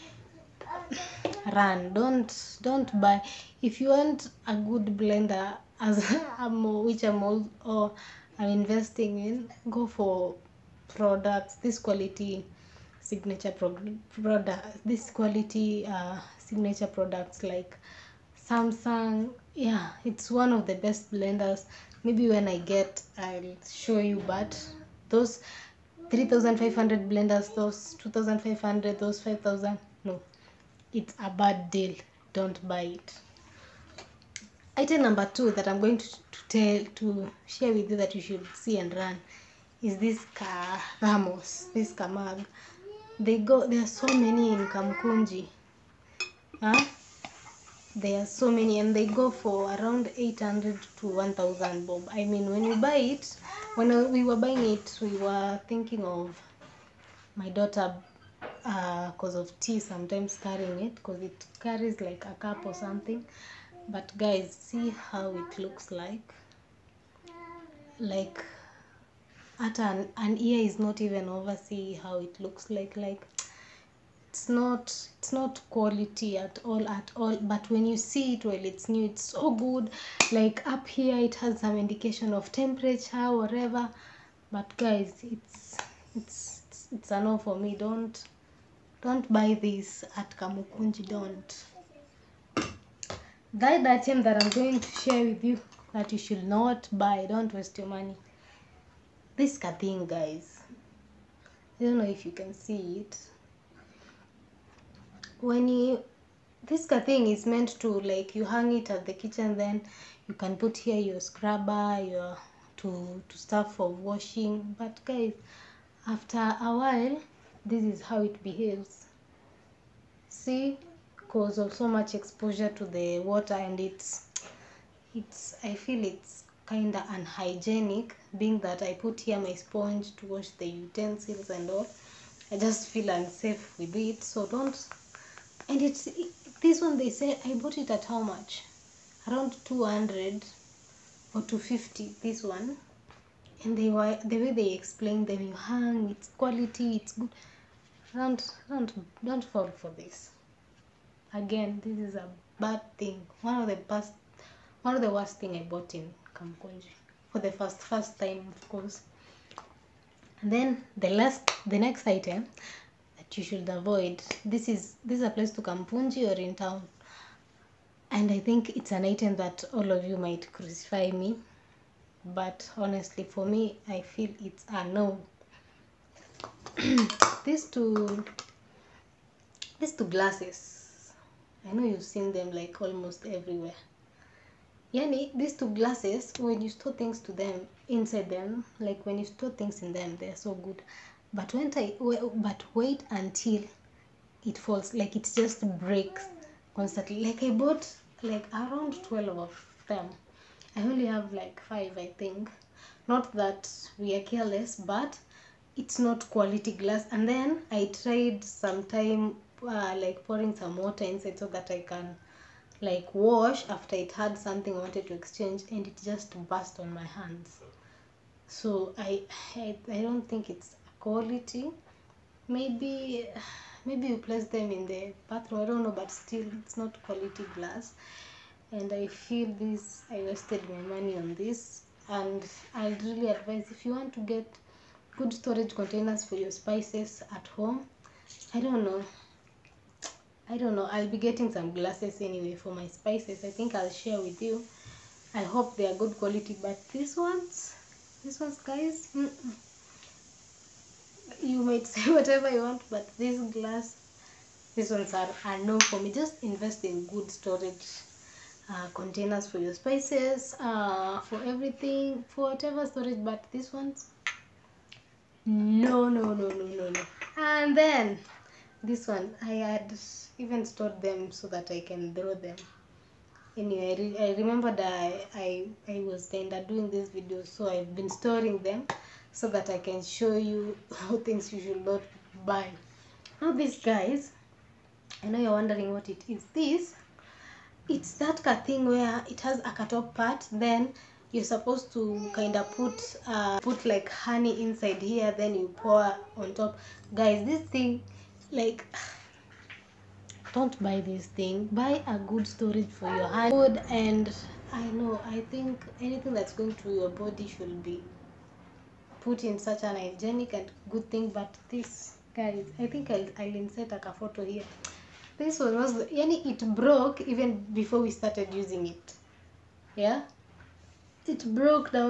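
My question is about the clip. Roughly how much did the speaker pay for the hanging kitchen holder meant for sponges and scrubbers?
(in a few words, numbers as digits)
200 or 250.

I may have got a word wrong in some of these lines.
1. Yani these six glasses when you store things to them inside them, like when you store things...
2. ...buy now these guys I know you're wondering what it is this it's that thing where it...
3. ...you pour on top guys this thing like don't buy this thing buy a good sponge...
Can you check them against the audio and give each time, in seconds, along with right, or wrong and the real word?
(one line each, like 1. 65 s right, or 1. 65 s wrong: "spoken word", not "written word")
1. 184 s wrong: "two", not "six"
2. 282 s right
3. 295 s wrong: "storage", not "sponge".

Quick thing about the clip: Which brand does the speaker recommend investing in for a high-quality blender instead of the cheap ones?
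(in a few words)
Samsung.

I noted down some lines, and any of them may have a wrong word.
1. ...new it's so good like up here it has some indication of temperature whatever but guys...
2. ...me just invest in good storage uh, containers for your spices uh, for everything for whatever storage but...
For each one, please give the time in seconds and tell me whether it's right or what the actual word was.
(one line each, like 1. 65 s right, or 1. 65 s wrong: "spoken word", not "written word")
1. 78 s right
2. 255 s right.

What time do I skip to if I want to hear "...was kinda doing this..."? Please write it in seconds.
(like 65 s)
276 s.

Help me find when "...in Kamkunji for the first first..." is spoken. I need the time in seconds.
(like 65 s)
155 s.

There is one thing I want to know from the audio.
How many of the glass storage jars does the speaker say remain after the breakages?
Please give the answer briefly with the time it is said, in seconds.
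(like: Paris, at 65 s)
5, at 201 s.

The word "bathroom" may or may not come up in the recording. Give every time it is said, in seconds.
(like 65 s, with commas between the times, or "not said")
225 s.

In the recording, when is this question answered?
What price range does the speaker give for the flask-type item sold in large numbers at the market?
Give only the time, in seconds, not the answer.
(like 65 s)
50 s.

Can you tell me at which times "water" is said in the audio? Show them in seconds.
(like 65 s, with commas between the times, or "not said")
123 s, 210 s.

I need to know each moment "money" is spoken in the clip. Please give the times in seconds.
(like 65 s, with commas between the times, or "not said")
97 s, 230 s.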